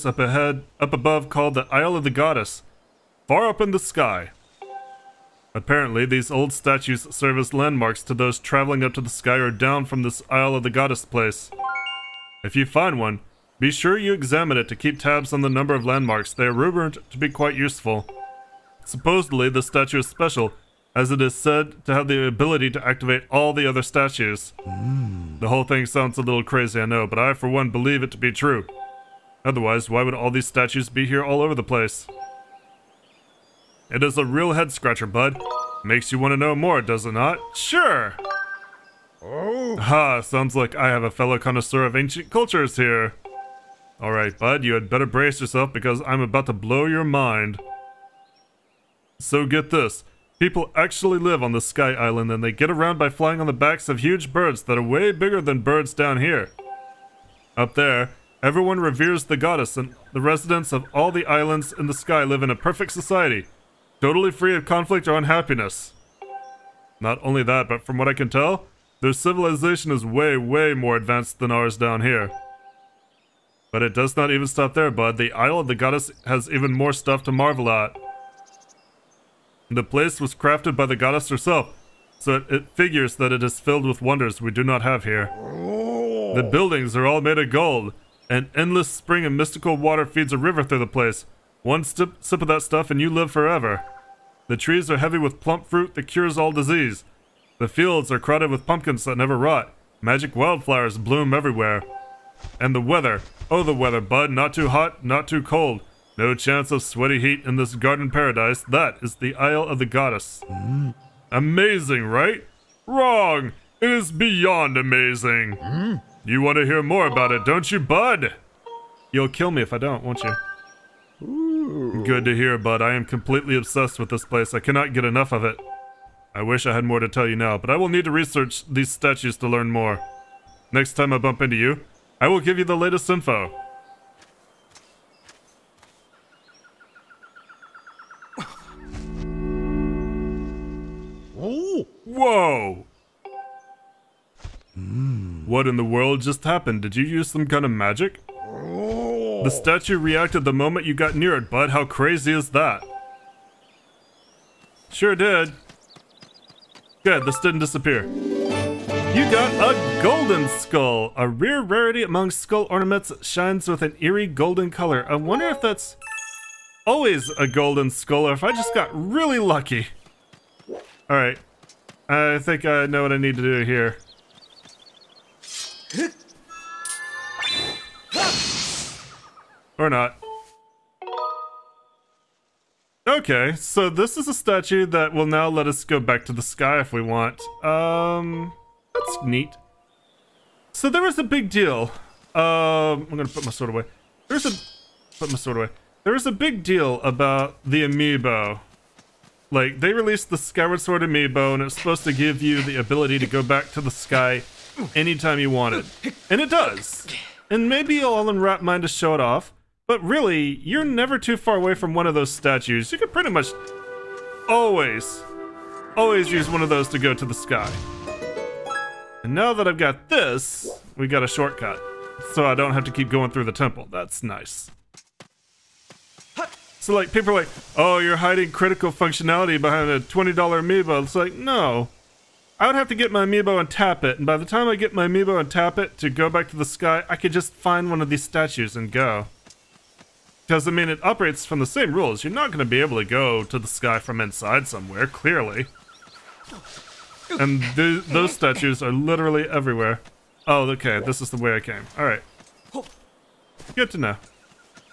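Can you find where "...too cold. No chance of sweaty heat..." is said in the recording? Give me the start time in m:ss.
1:45.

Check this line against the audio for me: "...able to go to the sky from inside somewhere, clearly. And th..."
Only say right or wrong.
right.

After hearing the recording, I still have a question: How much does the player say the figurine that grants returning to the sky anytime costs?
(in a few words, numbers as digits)
$20.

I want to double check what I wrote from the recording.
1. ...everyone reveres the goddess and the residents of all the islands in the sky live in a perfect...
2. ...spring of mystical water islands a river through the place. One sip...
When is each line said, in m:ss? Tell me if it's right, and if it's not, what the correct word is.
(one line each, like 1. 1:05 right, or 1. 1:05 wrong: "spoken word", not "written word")
1. 0:58 right
2. 1:28 wrong: "feeds", not "islands".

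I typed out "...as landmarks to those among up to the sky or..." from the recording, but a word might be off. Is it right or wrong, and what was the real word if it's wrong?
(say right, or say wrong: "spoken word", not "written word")
wrong: "traveling", not "among".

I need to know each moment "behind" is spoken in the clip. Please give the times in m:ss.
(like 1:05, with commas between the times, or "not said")
3:49.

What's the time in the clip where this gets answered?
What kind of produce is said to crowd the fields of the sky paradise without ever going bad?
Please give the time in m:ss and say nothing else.
1:38.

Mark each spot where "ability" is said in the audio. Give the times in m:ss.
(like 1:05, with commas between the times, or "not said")
0:22, 3:22.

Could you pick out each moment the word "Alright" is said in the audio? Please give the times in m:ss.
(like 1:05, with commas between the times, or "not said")
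0:44, 2:51.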